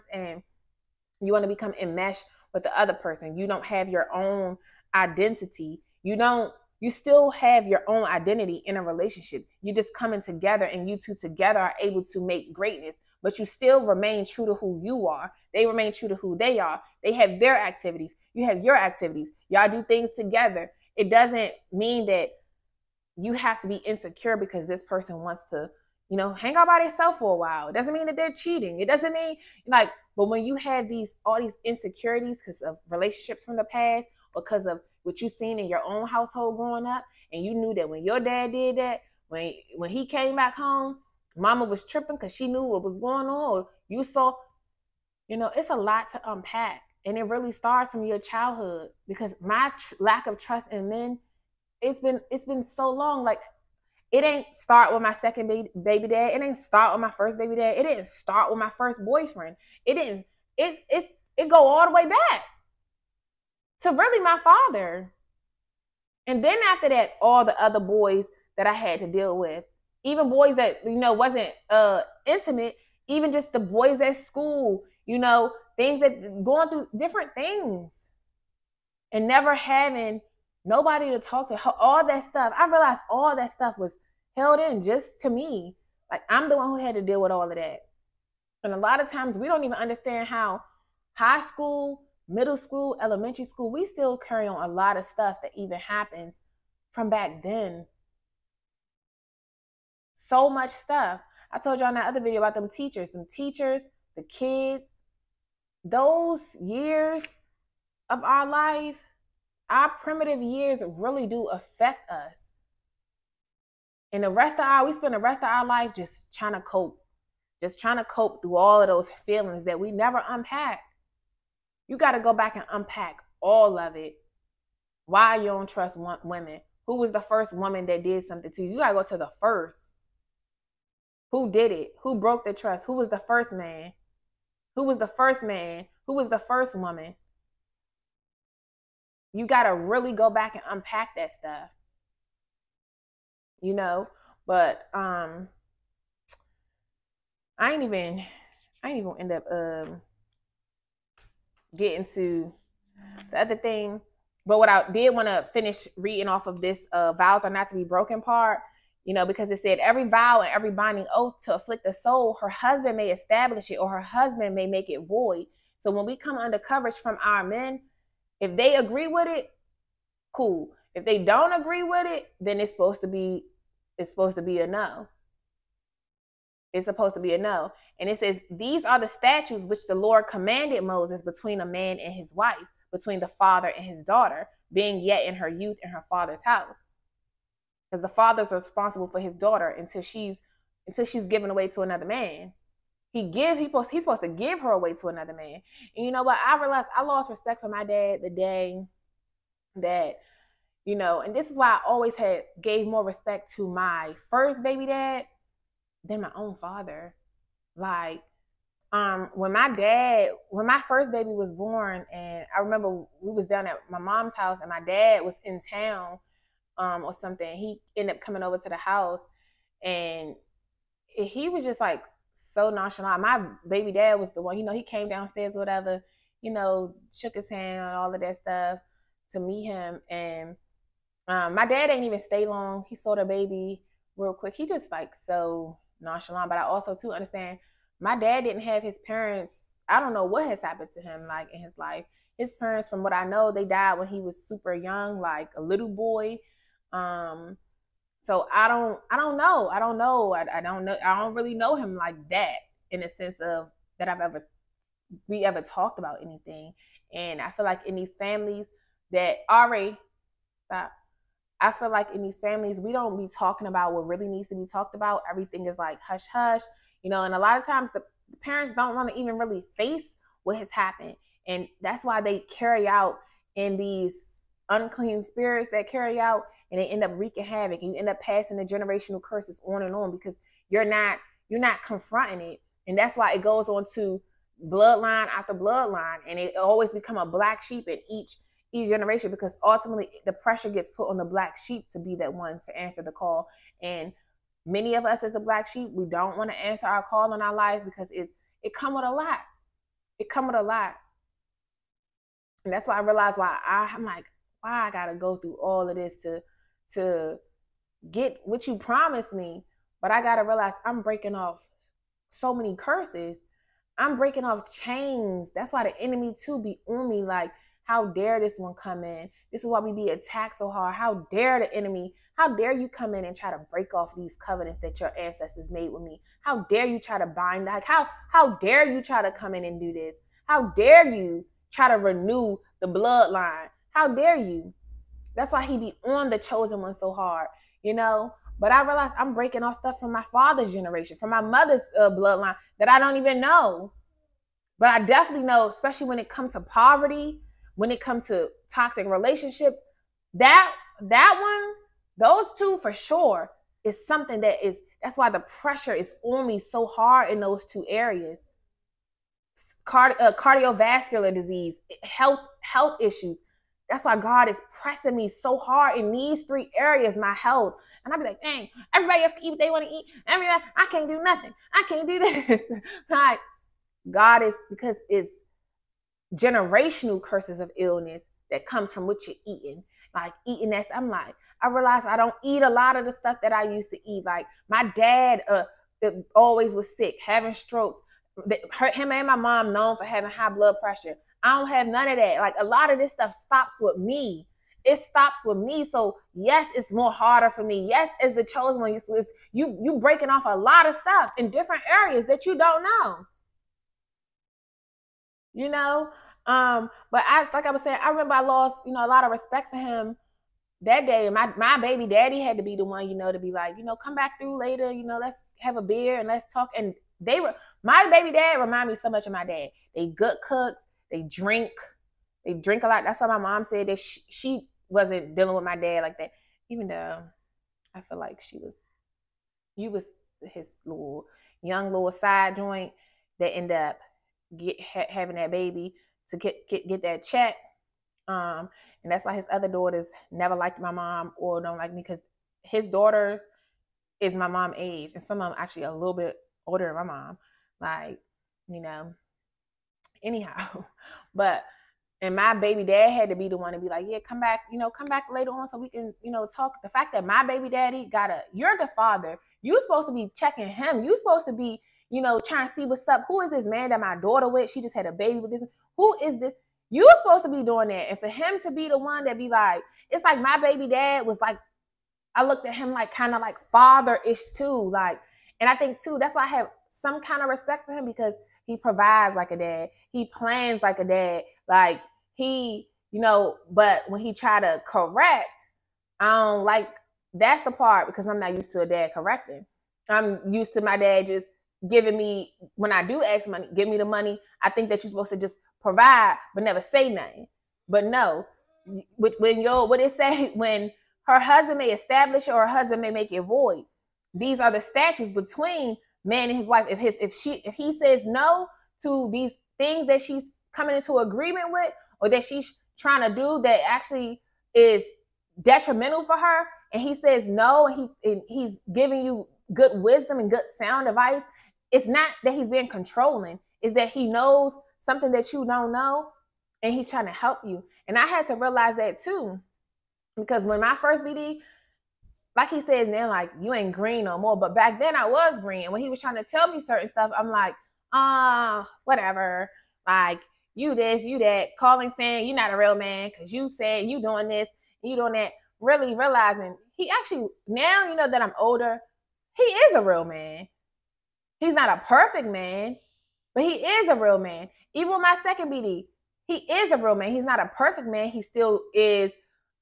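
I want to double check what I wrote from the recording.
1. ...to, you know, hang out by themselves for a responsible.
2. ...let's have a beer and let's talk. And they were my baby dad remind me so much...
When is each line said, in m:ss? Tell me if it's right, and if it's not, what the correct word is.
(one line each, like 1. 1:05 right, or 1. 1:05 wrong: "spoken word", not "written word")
1. 0:25 wrong: "while", not "responsible"
2. 6:55 right.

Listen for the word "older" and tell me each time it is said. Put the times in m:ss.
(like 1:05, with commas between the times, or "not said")
7:26, 9:08.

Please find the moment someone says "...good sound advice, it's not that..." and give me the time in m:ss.
8:40.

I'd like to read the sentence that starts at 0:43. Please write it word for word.
you saw, you know, it's a lot to unpack.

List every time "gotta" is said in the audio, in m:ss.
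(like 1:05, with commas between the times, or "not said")
5:04, 5:10.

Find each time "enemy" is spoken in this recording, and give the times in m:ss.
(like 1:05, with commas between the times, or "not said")
5:15, 5:21.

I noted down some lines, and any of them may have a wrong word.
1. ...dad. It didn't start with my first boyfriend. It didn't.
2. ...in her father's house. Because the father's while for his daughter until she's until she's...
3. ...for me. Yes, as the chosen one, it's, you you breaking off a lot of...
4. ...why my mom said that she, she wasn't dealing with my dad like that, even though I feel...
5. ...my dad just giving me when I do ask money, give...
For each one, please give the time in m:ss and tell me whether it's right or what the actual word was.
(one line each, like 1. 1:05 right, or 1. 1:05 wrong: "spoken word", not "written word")
1. 0:57 right
2. 3:05 wrong: "responsible", not "while"
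3. 6:37 right
4. 7:03 right
5. 8:10 right.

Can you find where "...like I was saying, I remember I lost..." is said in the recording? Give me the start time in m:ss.
6:47.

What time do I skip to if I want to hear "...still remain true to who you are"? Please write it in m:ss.
0:13.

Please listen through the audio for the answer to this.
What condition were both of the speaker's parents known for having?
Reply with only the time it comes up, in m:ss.
6:30.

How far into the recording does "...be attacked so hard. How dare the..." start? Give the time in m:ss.
5:19.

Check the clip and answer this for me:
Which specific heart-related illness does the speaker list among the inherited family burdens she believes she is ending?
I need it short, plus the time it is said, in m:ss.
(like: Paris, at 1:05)
Cardiovascular disease, at 6:00.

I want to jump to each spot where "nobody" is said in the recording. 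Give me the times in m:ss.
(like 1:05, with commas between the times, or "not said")
1:20.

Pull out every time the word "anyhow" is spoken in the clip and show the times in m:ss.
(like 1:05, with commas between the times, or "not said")
7:30.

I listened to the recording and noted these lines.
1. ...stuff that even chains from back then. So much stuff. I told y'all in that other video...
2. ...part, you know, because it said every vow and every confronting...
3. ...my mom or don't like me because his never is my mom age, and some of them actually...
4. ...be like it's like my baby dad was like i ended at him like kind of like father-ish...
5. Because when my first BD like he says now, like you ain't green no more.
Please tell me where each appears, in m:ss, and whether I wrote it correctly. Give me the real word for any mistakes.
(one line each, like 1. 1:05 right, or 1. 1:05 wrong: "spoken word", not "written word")
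1. 1:35 wrong: "happens", not "chains"
2. 2:38 wrong: "binding", not "confronting"
3. 7:20 wrong: "daughter", not "never"
4. 7:49 wrong: "looked", not "ended"
5. 8:50 right.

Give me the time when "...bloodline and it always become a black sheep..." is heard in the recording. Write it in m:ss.
4:45.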